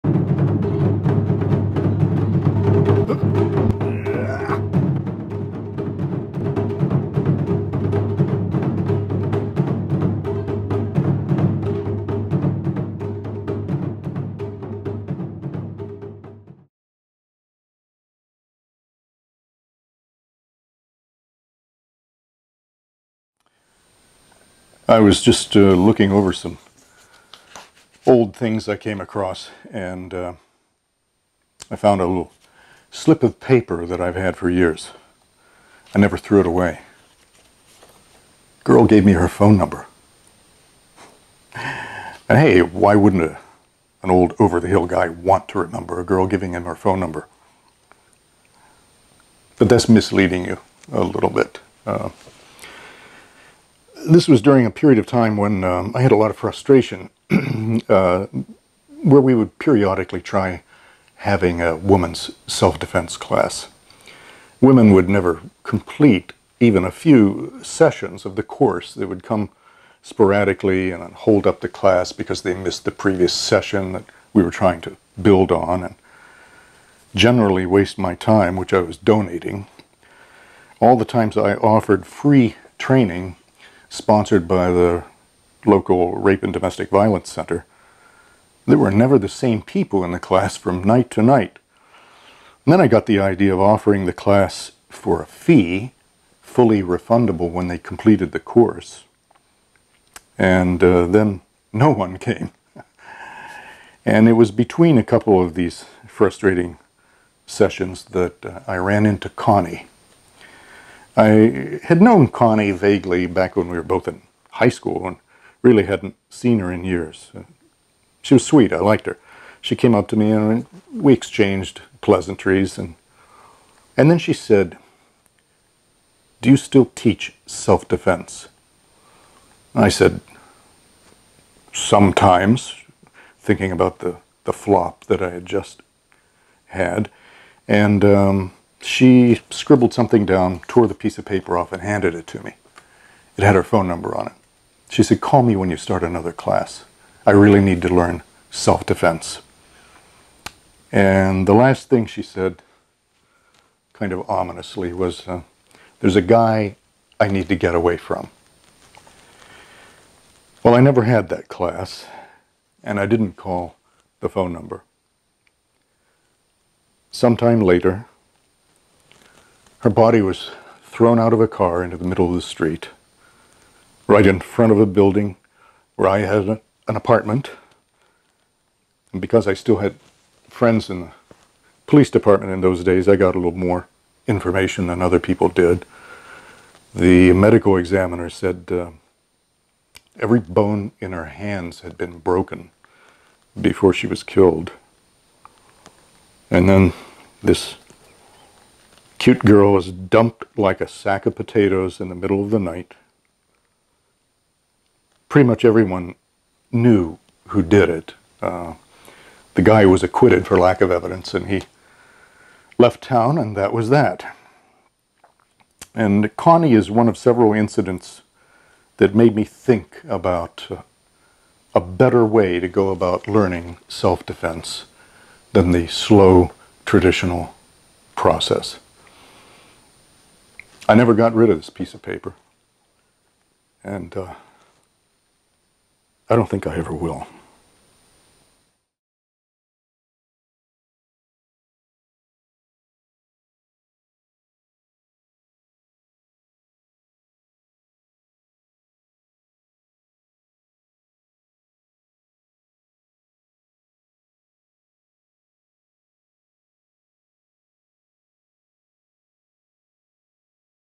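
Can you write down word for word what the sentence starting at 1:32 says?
And then I got the idea of offering the class for a fee, fully refundable when they completed the course.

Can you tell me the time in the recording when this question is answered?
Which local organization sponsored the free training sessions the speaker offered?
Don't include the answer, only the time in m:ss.
1:26.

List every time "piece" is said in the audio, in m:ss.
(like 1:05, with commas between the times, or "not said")
2:20, 3:51.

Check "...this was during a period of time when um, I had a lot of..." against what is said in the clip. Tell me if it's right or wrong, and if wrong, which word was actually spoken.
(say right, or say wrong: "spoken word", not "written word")
right.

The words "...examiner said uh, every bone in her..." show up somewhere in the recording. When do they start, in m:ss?
3:07.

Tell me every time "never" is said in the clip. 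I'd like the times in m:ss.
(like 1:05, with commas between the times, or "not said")
0:35, 1:05, 1:28, 2:40, 3:50.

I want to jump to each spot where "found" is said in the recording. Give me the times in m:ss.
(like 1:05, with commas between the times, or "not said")
0:31.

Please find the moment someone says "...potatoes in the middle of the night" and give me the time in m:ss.
3:21.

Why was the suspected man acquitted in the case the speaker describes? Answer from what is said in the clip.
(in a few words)
Lack of evidence.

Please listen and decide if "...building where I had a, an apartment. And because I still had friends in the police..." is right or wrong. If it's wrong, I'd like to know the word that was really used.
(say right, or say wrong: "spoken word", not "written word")
right.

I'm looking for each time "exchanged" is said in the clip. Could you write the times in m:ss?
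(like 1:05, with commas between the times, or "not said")
2:01.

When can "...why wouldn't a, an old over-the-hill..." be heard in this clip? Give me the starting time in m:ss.
0:42.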